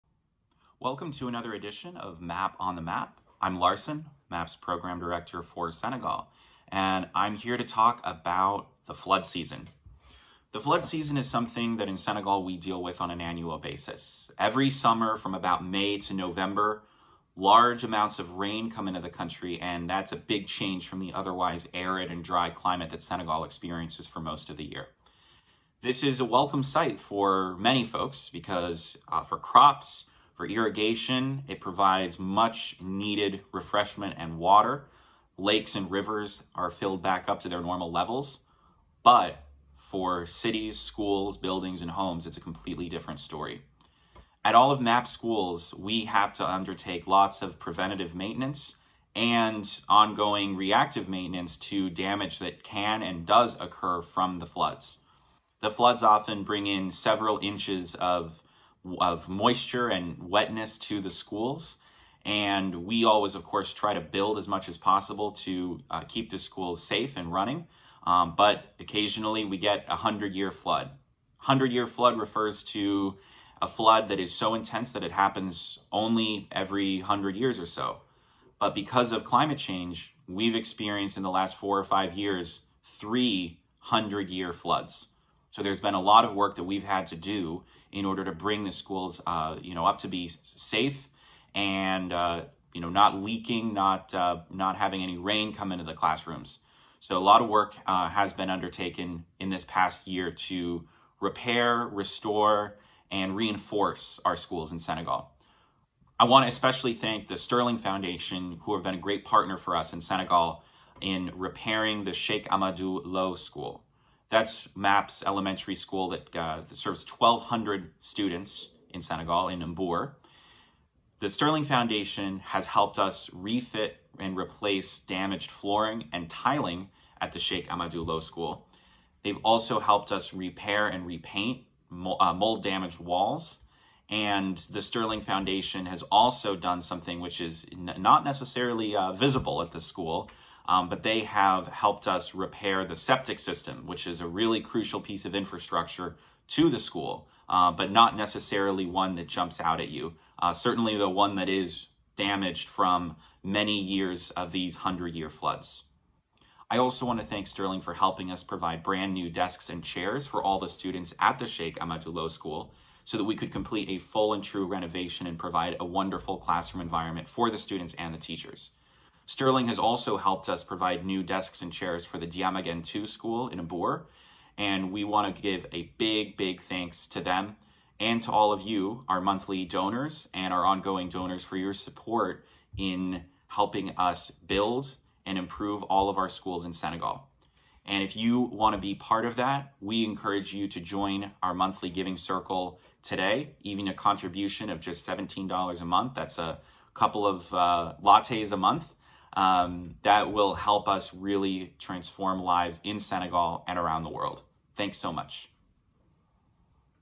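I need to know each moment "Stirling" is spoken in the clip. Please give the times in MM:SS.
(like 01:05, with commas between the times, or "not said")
01:47, 02:01, 02:14, 02:37, 02:49.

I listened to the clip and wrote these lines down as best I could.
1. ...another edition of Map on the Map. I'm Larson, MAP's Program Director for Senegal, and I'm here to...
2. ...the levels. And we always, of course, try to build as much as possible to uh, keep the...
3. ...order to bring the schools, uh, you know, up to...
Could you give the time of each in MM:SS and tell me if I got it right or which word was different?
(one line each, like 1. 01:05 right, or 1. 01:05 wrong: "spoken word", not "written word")
1. 00:01 right
2. 01:01 wrong: "schools", not "levels"
3. 01:28 right.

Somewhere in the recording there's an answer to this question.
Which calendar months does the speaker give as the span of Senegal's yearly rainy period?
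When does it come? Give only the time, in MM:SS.
00:15.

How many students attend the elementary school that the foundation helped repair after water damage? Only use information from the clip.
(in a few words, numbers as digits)
1,200.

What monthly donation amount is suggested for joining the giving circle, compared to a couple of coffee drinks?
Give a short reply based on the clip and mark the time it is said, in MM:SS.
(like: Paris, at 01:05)
$17, at 03:15.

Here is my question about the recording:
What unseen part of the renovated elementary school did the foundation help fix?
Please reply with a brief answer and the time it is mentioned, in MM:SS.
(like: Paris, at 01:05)
septic system, at 02:22.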